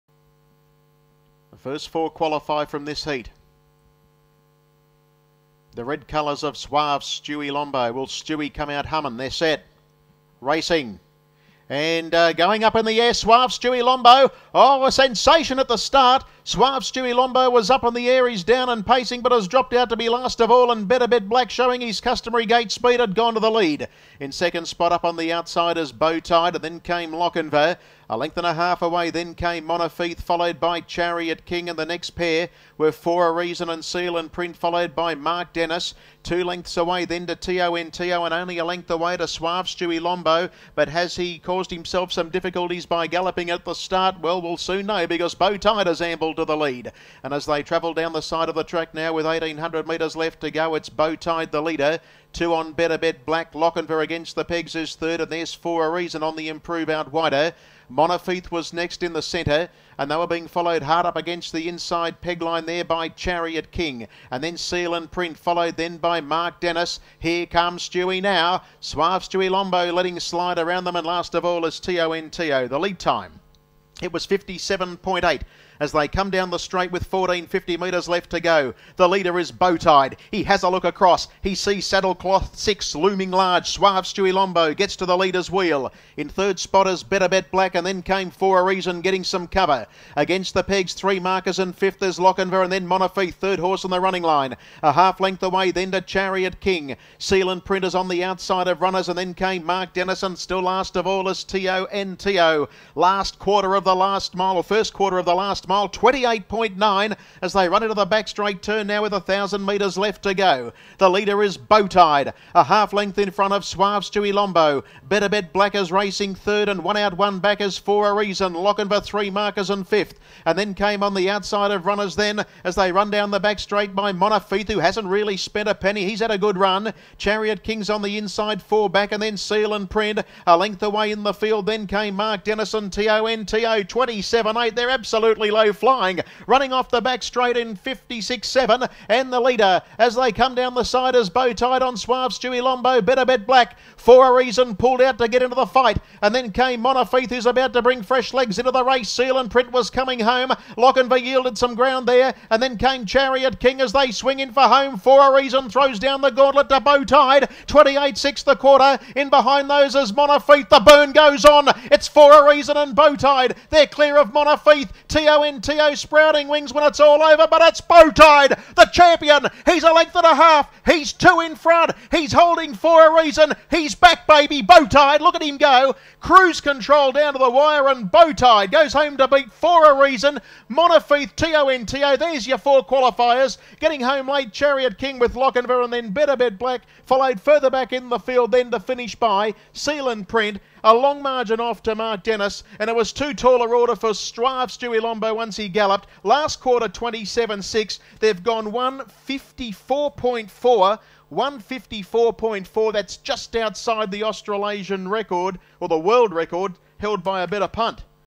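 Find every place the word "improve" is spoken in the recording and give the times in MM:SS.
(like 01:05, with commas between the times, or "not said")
00:56.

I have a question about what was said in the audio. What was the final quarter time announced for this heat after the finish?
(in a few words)
27.6.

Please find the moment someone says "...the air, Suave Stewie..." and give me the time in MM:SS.
00:12.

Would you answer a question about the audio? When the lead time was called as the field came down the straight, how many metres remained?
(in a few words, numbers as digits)
1450.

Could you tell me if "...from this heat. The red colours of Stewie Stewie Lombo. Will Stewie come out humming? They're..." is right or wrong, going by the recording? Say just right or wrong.
wrong.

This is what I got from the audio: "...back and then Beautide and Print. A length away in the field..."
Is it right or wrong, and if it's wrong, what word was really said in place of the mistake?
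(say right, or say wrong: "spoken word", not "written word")
wrong: "Seal", not "Beautide".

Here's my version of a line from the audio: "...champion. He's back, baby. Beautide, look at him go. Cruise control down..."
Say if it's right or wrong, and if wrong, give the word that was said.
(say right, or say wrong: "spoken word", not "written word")
wrong: "reason", not "champion".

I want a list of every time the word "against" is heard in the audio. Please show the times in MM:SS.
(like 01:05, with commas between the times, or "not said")
00:54, 01:01, 01:30.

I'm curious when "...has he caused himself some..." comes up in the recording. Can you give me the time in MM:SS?
00:40.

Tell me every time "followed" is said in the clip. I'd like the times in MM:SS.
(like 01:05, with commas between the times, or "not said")
00:30, 00:34, 01:00, 01:05, 03:07.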